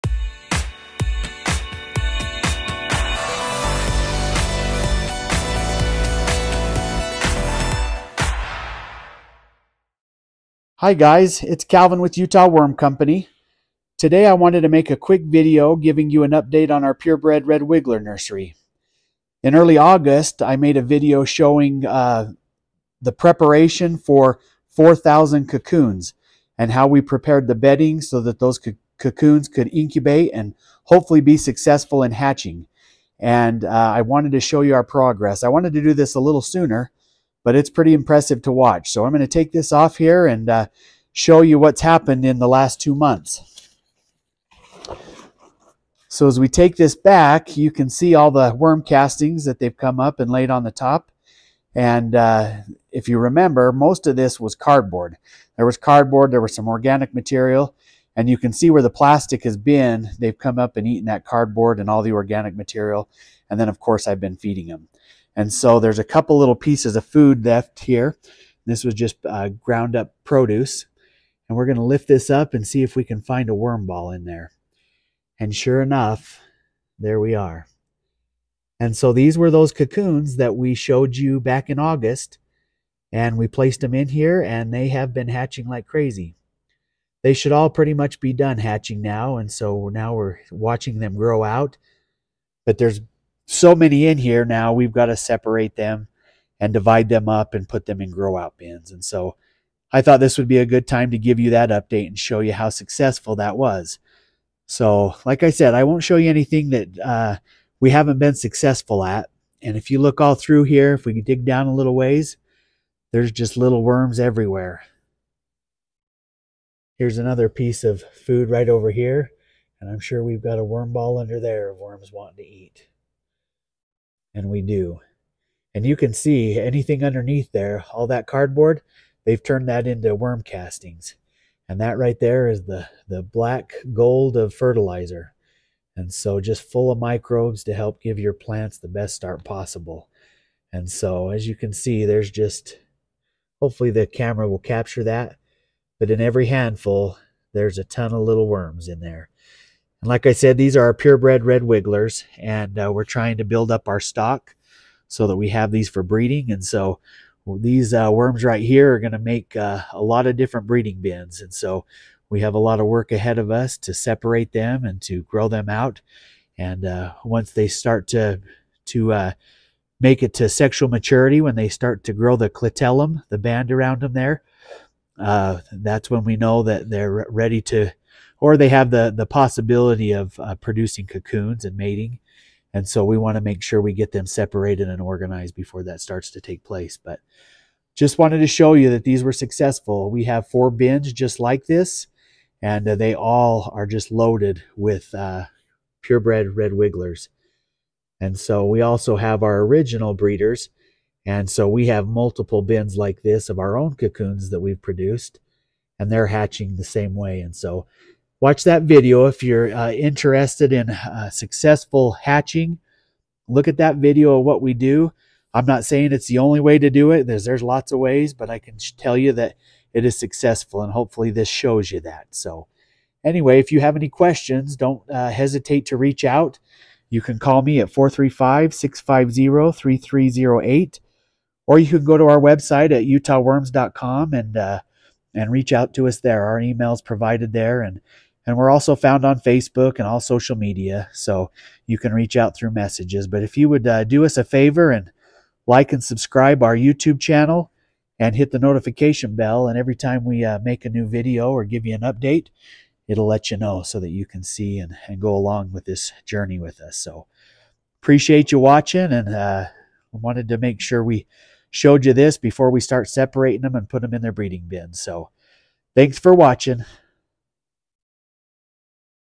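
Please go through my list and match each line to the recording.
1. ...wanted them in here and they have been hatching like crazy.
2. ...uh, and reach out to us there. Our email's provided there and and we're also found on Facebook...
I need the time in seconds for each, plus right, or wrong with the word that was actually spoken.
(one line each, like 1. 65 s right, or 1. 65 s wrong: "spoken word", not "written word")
1. 83 s wrong: "placed", not "wanted"
2. 234 s right.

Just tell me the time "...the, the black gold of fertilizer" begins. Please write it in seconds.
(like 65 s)
132 s.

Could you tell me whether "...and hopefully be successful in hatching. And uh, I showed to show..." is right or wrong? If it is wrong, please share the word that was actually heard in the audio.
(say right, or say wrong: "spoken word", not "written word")
wrong: "wanted", not "showed".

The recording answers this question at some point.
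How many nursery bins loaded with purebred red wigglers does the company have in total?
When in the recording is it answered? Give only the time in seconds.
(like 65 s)
190 s.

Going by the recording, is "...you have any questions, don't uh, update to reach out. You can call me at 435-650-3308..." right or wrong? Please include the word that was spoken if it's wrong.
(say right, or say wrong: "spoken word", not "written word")
wrong: "hesitate", not "update".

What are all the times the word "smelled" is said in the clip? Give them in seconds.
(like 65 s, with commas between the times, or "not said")
not said.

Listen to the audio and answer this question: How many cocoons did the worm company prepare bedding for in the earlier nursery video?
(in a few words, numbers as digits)
4,000.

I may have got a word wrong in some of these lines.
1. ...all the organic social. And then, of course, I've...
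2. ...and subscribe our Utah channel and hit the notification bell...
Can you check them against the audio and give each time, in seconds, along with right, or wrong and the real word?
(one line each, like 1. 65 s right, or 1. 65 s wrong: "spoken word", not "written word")
1. 61 s wrong: "material", not "social"
2. 245 s wrong: "YouTube", not "Utah".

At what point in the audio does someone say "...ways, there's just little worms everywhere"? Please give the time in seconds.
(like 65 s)
111 s.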